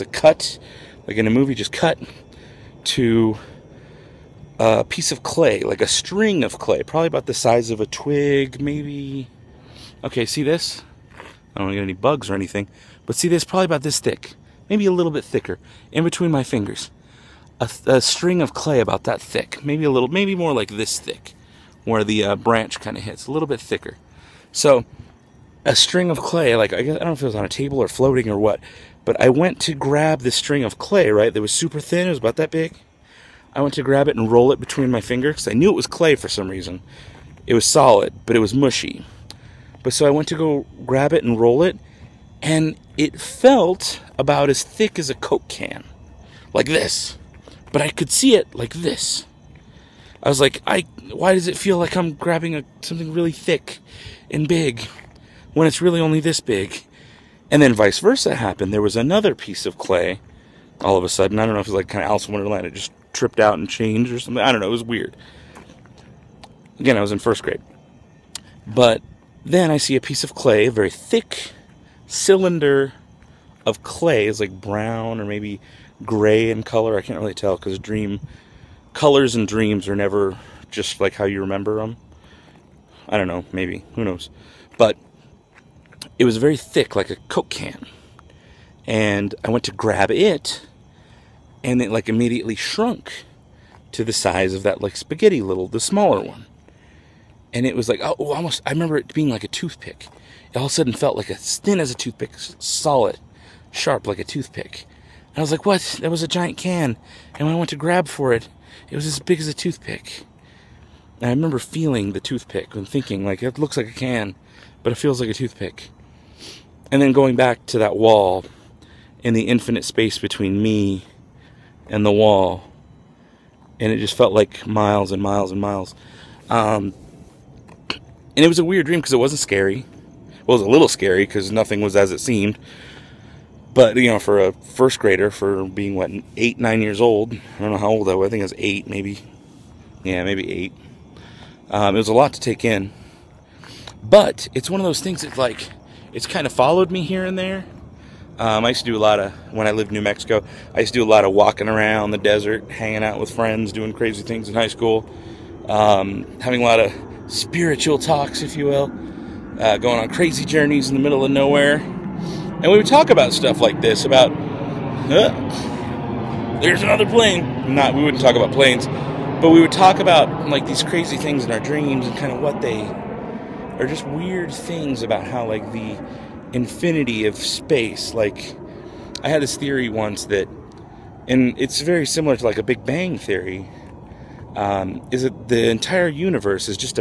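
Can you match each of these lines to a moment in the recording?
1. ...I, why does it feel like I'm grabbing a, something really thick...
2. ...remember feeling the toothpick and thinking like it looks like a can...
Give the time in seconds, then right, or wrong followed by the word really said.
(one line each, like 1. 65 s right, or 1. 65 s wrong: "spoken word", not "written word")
1. 50 s right
2. 111 s right.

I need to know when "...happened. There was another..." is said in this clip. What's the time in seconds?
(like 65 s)
58 s.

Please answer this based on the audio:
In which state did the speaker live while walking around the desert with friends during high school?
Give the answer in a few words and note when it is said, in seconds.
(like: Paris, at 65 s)
New Mexico, at 149 s.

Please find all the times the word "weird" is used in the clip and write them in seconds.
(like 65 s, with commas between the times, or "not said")
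64 s, 128 s, 174 s.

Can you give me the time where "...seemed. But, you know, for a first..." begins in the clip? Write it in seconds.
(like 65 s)
132 s.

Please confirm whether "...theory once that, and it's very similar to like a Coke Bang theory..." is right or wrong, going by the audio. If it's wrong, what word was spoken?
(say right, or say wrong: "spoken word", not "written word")
wrong: "Big", not "Coke".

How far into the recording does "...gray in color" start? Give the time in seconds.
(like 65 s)
76 s.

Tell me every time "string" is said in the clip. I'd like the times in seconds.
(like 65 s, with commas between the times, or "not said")
5 s, 18 s, 25 s, 30 s.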